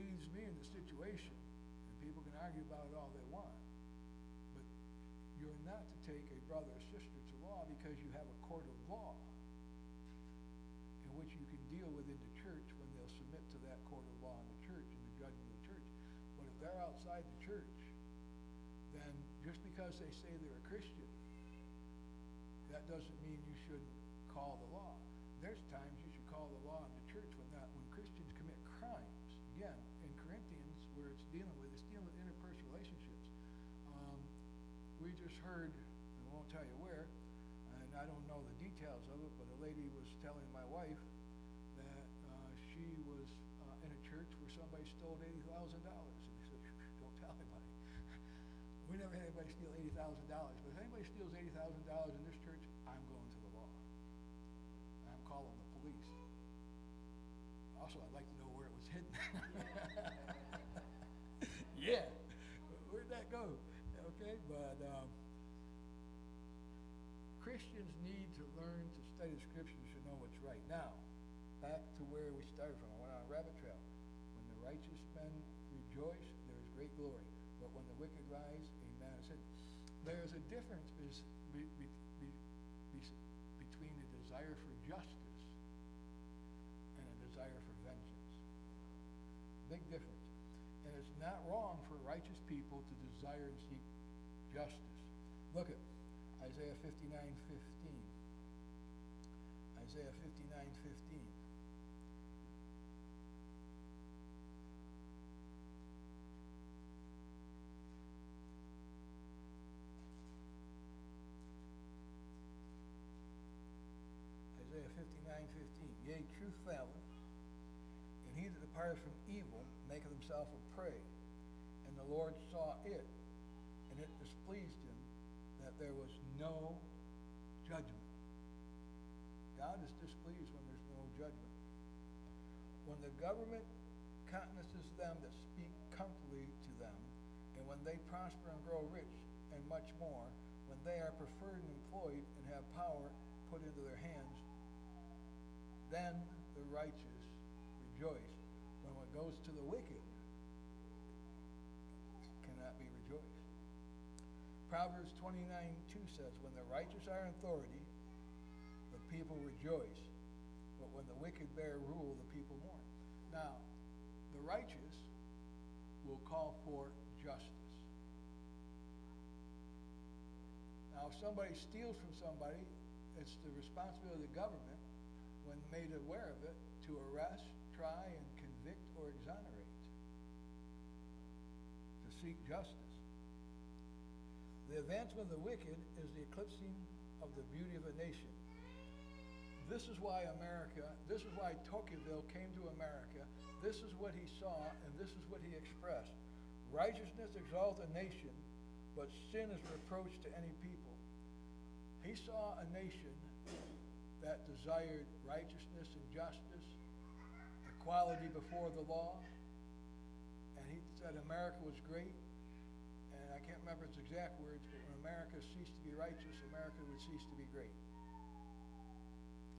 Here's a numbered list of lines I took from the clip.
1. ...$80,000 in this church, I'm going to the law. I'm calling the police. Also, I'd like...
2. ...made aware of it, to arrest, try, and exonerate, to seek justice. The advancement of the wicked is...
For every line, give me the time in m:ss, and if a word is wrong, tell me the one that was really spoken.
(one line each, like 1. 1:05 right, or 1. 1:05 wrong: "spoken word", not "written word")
1. 0:51 right
2. 2:55 right.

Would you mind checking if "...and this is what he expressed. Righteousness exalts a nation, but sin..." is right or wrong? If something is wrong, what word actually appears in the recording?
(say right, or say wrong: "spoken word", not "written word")
right.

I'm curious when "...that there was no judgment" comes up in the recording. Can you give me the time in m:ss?
2:05.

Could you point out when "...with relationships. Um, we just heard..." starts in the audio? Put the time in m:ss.
0:31.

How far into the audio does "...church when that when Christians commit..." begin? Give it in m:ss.
0:27.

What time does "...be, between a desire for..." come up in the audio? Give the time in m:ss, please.
1:22.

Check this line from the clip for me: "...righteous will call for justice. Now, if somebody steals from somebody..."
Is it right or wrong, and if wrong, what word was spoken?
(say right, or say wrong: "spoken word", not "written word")
right.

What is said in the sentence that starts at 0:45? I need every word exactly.
And they said, don't tell anybody.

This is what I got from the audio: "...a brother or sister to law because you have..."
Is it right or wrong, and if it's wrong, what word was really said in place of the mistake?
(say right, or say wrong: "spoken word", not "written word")
right.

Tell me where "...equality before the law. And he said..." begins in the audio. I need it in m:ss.
3:27.